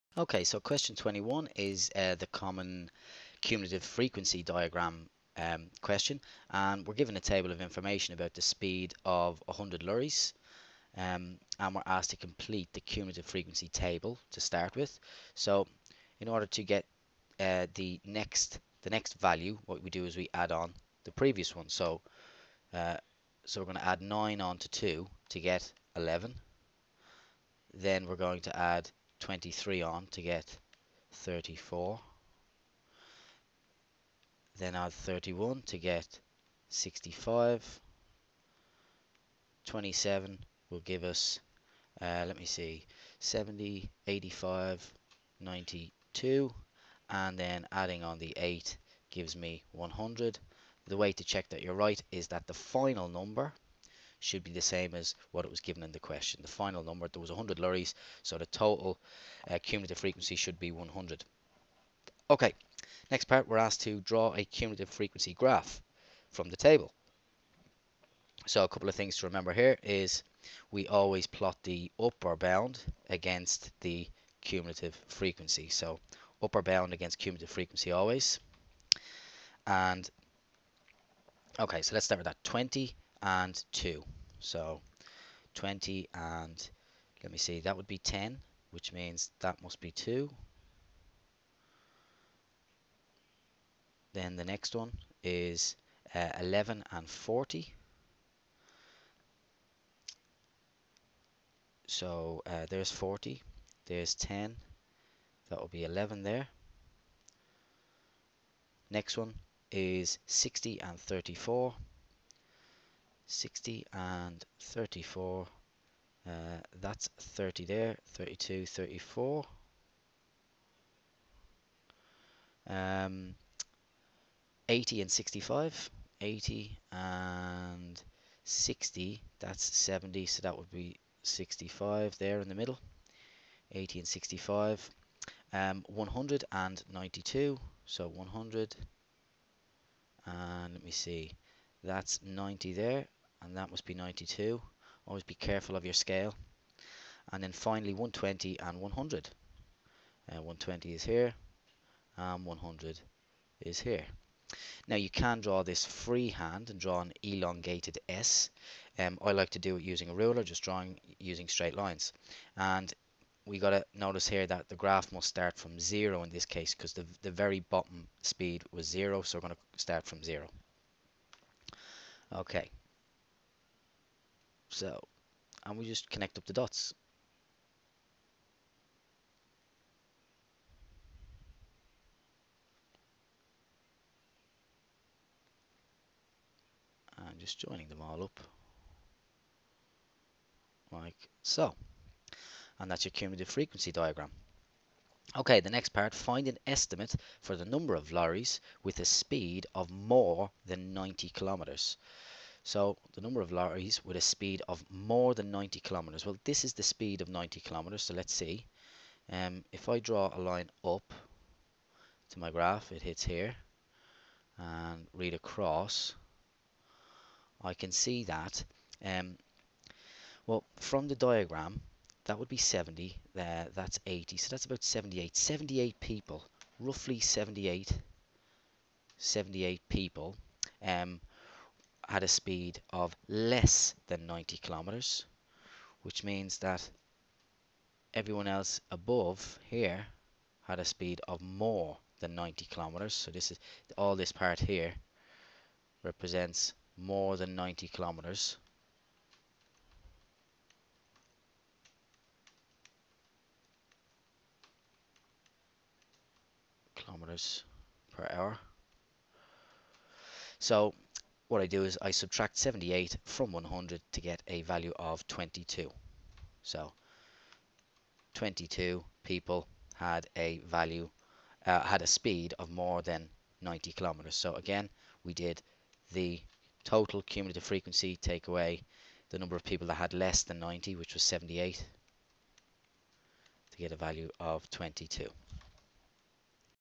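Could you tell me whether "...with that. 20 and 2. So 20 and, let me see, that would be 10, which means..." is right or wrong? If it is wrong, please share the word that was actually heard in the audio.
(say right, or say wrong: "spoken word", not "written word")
right.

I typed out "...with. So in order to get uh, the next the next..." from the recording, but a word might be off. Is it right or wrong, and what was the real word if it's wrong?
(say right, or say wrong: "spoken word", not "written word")
right.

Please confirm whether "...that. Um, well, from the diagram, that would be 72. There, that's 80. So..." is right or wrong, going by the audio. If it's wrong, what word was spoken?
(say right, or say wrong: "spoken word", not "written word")
wrong: "70", not "72".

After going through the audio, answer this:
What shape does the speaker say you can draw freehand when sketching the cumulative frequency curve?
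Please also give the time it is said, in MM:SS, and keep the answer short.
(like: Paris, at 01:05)
elongated S, at 02:37.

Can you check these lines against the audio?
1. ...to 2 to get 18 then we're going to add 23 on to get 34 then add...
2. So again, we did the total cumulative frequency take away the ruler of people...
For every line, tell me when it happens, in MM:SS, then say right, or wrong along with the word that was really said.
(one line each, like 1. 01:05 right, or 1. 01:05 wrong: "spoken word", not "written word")
1. 00:24 wrong: "11", not "18"
2. 04:34 wrong: "number", not "ruler".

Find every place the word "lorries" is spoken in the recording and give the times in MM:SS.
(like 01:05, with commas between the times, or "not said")
00:09, 00:57, 03:18, 03:23.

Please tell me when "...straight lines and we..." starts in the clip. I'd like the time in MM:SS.
02:41.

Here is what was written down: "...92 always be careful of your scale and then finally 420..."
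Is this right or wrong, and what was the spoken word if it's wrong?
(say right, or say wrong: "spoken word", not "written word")
wrong: "120", not "420".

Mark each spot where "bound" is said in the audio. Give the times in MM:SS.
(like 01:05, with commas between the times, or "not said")
01:12, 01:16.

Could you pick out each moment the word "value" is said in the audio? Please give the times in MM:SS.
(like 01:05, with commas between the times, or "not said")
00:19, 04:24, 04:30, 04:43.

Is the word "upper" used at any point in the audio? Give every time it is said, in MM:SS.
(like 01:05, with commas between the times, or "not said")
01:11, 01:16.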